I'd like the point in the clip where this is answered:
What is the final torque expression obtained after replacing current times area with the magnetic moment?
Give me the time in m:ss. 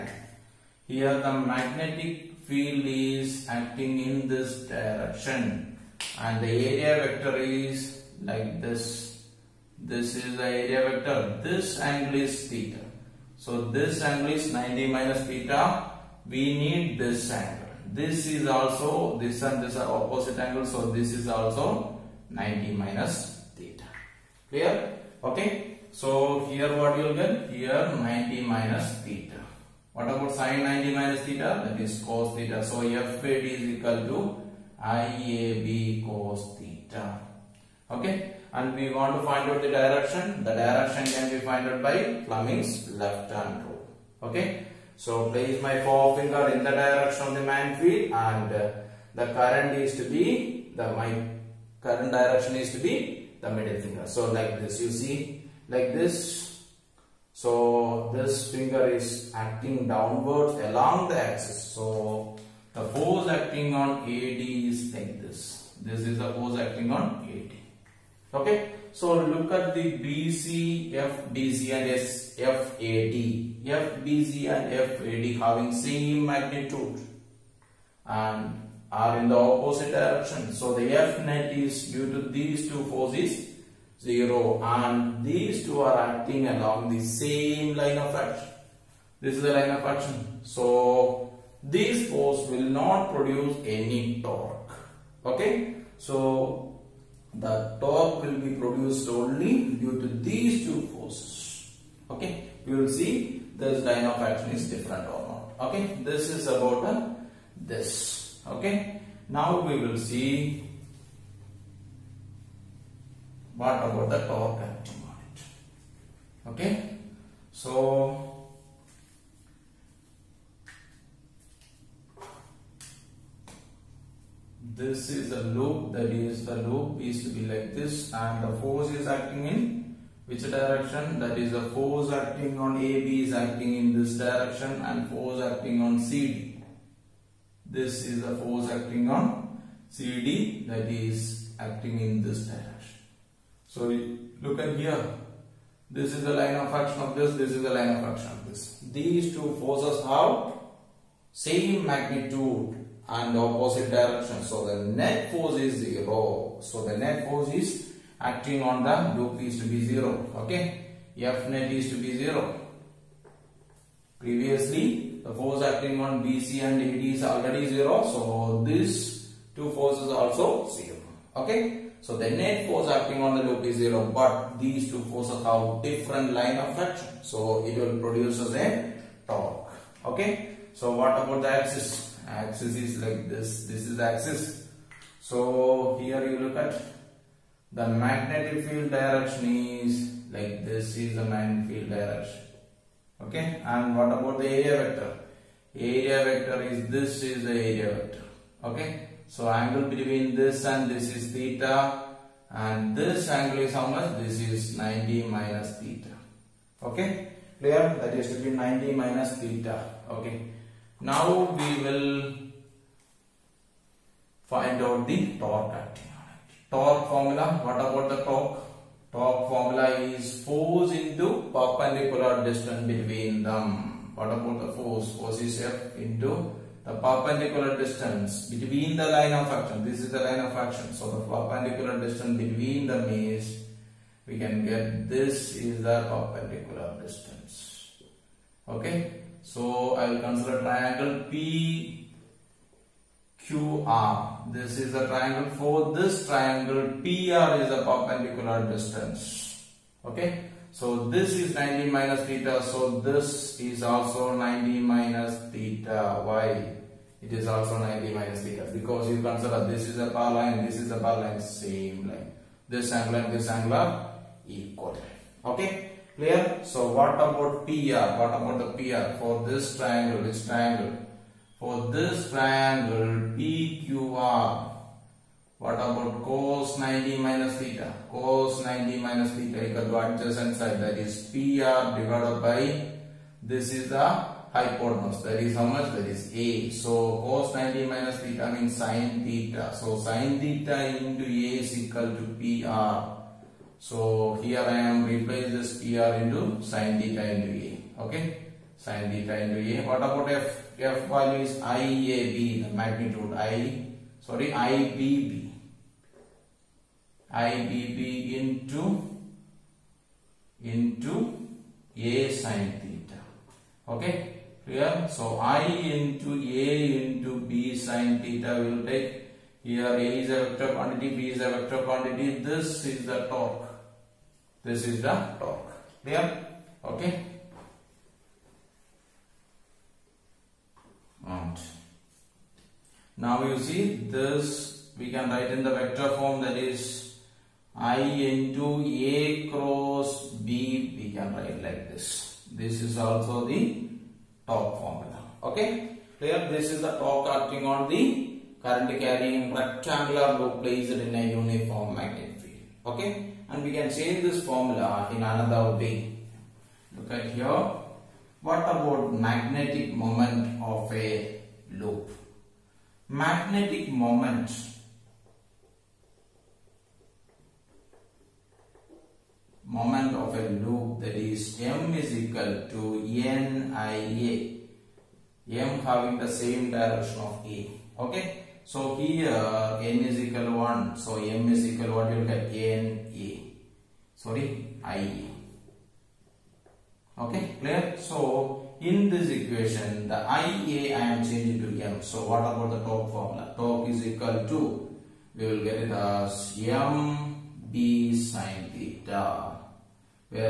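6:36.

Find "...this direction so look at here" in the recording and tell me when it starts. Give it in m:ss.
2:22.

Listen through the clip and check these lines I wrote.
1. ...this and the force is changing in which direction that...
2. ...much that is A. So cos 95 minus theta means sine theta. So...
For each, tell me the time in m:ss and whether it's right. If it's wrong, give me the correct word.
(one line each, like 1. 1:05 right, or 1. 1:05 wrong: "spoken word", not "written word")
1. 2:07 wrong: "acting", not "changing"
2. 4:45 wrong: "90", not "95".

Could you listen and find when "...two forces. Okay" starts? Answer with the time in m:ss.
1:40.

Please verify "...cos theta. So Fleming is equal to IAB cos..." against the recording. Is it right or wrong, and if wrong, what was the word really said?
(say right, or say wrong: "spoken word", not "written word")
wrong: "FAD", not "Fleming".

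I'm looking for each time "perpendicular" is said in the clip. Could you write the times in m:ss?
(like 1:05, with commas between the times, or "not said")
3:41, 3:46, 3:51, 3:56, 4:07.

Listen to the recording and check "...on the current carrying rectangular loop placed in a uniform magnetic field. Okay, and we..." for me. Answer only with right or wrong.
right.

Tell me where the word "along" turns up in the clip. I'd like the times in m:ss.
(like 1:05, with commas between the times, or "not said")
1:00, 1:26.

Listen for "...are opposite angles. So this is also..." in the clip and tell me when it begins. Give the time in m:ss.
0:19.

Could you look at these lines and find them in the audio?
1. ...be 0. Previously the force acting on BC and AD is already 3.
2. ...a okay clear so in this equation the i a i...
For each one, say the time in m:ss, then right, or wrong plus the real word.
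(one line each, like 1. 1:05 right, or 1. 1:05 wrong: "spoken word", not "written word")
1. 2:41 wrong: "0", not "3"
2. 6:25 right.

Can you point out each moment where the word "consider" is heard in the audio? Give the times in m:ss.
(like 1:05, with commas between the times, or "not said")
4:00, 4:19.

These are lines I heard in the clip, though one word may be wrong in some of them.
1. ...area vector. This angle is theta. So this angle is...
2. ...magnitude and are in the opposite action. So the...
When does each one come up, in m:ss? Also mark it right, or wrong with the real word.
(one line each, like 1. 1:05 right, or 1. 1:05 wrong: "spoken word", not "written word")
1. 0:10 right
2. 1:16 wrong: "direction", not "action".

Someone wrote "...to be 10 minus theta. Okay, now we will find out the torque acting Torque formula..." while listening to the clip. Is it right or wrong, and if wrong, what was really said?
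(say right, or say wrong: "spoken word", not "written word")
wrong: "90", not "10".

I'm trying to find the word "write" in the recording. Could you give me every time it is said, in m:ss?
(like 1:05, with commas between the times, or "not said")
5:35, 5:41.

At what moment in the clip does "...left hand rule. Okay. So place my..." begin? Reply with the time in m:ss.
0:42.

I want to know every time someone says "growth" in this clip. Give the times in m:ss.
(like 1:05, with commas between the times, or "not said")
not said.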